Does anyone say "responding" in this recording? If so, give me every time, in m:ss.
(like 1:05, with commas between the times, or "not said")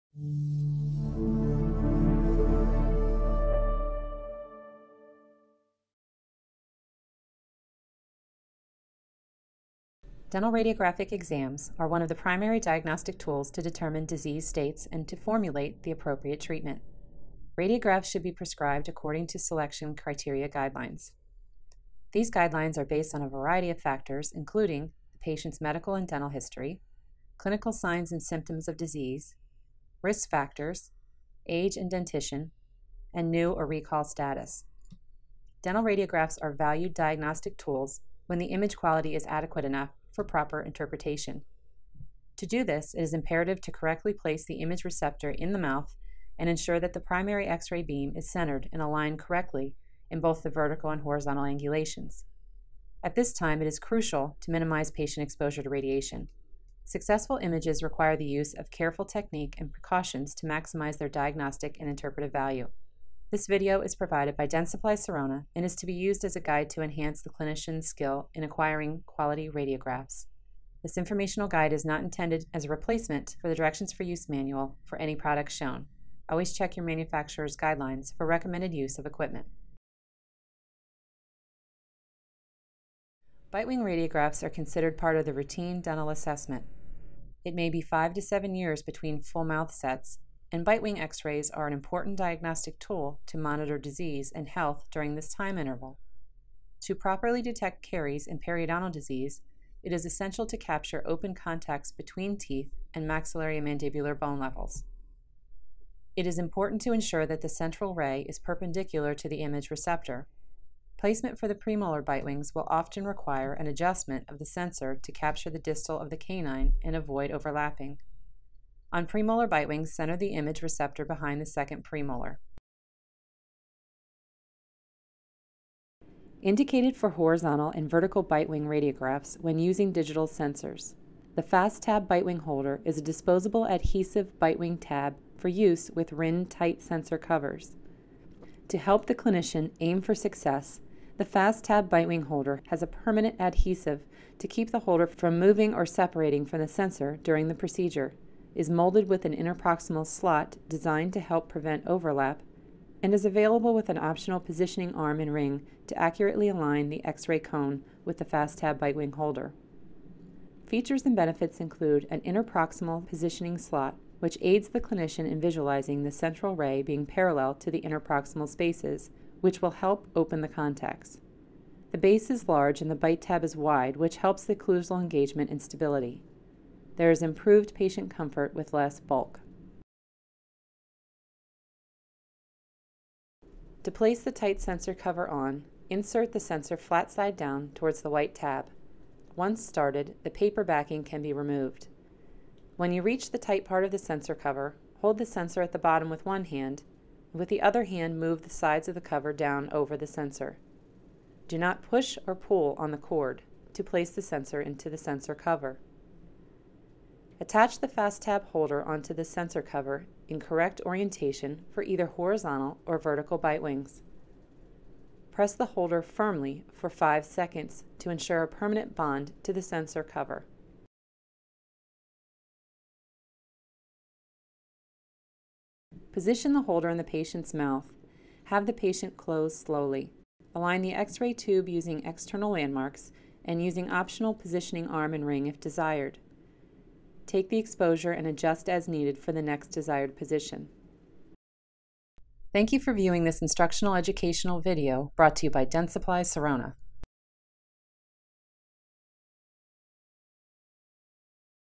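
not said.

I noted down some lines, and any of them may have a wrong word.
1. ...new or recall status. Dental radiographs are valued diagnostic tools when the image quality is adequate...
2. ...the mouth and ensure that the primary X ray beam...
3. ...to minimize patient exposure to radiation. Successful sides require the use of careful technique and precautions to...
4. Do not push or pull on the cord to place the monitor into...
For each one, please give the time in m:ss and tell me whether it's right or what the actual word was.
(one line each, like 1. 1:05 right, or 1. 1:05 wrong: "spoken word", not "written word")
1. 0:33 right
2. 0:45 right
3. 0:54 wrong: "images", not "sides"
4. 3:21 wrong: "sensor", not "monitor".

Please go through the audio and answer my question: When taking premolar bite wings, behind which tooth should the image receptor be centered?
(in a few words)
Second premolar.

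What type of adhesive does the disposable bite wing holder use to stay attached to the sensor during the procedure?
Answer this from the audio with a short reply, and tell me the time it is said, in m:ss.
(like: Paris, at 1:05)
Permanent adhesive, at 2:22.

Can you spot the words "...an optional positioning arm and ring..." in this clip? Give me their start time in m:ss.
2:33.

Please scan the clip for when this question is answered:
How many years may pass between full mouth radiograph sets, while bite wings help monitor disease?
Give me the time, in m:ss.
1:27.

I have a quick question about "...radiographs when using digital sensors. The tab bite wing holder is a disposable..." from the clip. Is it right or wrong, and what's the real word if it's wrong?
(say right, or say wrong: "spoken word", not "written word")
right.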